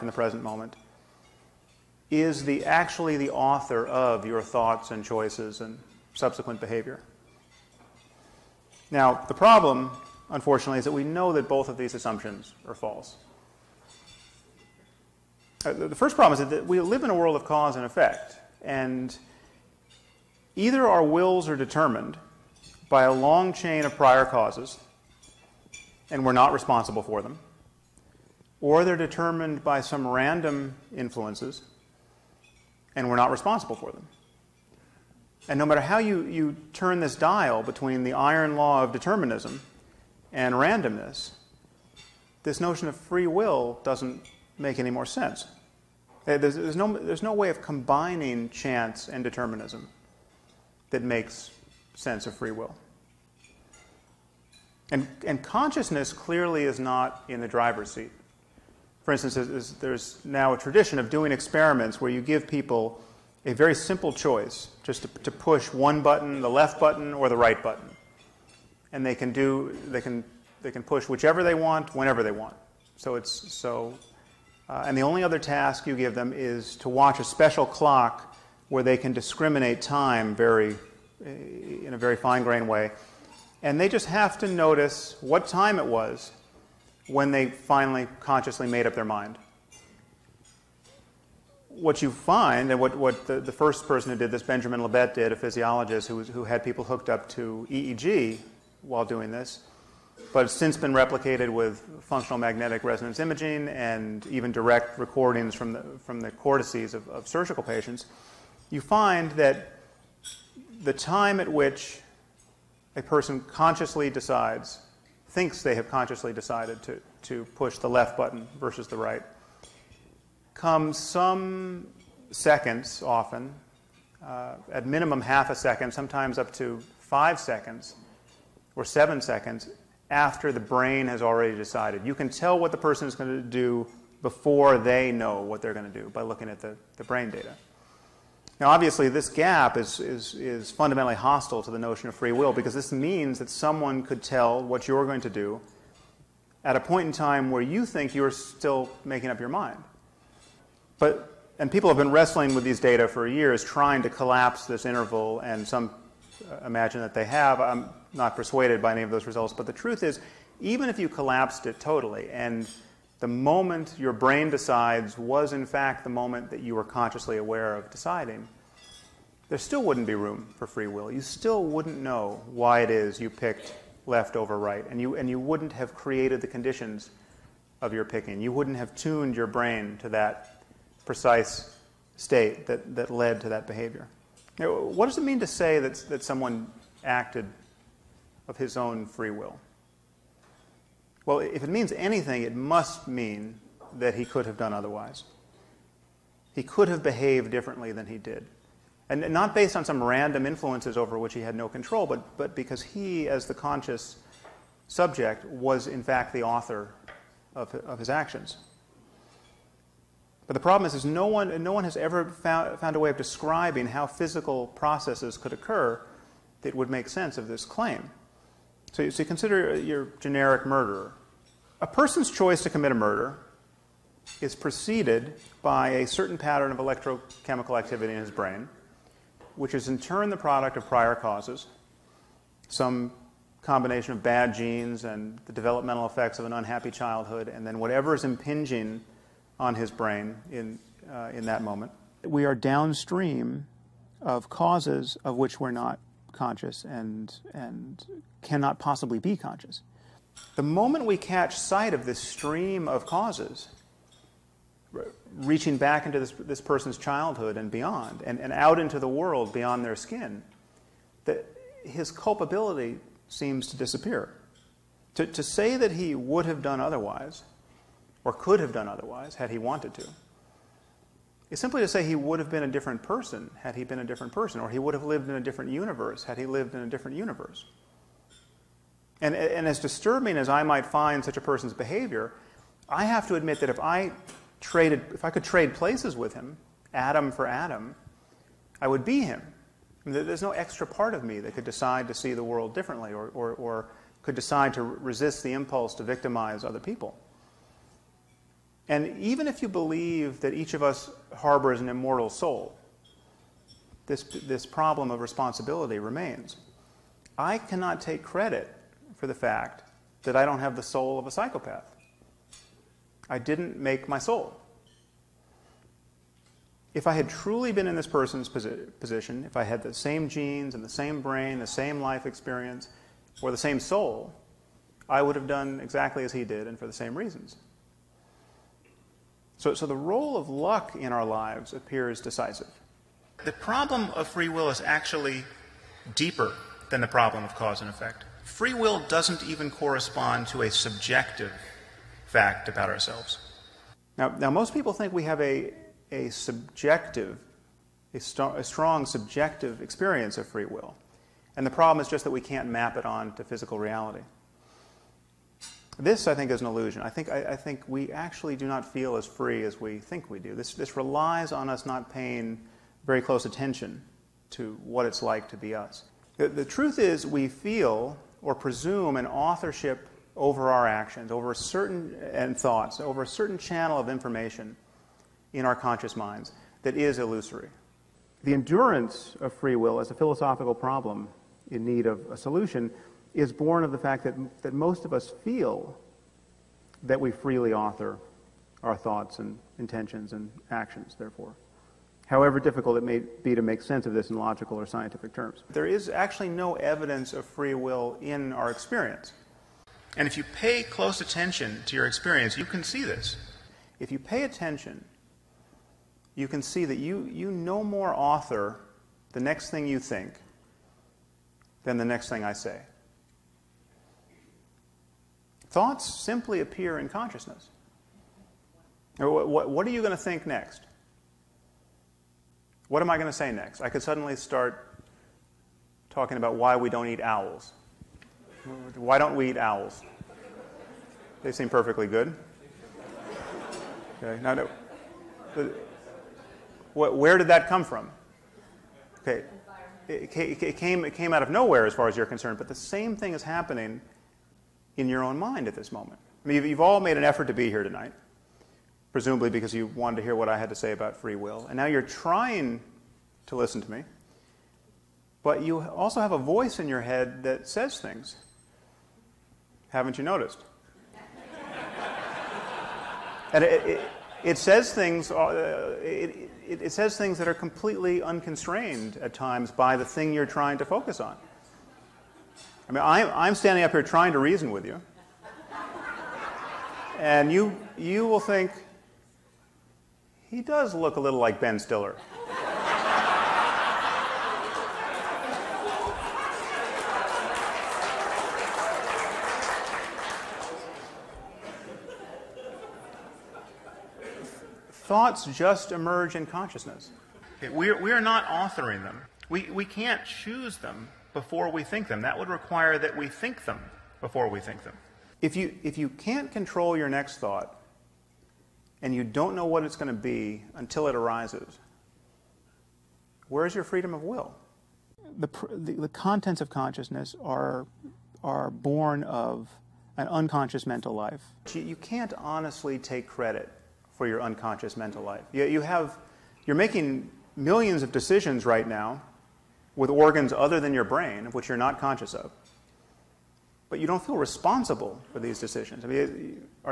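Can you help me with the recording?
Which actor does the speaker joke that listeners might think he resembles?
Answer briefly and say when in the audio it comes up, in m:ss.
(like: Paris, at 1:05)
Ben Stiller, at 8:01.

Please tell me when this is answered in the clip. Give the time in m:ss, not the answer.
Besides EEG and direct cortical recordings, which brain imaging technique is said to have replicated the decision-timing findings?
1:42.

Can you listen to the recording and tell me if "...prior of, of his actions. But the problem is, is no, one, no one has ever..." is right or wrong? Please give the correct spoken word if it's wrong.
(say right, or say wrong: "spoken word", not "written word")
wrong: "author", not "prior".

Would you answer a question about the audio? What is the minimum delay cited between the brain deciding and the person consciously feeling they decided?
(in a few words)
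half a second.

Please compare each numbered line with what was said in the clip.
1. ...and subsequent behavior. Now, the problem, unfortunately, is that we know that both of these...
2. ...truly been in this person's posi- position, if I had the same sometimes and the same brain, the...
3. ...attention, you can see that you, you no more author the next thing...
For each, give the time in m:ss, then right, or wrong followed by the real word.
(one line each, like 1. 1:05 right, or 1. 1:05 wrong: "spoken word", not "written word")
1. 0:05 right
2. 5:17 wrong: "genes", not "sometimes"
3. 6:44 right.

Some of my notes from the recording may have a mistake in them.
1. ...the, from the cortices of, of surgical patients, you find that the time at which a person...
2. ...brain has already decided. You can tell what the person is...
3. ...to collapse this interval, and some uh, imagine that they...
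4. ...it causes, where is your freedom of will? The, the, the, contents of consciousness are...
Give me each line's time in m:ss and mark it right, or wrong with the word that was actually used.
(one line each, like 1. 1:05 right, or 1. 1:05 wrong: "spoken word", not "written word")
1. 1:45 right
2. 2:10 right
3. 2:34 right
4. 8:31 wrong: "arises", not "causes".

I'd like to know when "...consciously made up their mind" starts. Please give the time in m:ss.
1:28.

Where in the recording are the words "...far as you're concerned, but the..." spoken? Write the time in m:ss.
7:21.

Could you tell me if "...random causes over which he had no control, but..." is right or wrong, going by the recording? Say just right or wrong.
wrong.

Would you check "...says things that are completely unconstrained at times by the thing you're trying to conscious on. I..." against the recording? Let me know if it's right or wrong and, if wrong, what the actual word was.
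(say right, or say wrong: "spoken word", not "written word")
wrong: "focus", not "conscious".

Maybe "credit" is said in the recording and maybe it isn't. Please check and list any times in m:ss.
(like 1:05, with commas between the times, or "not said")
5:08, 8:43.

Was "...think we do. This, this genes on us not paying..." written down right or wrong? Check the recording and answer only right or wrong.
wrong.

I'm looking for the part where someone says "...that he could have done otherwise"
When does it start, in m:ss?
3:13.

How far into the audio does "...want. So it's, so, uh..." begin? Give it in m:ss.
1:12.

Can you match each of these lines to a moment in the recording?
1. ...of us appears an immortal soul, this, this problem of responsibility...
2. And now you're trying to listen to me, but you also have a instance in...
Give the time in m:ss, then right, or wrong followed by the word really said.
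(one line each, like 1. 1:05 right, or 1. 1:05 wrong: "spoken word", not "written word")
1. 5:00 wrong: "harbors", not "appears"
2. 7:31 wrong: "voice", not "instance".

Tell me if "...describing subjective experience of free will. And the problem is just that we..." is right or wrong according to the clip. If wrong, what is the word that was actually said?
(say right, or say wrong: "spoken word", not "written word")
wrong: "strong", not "describing".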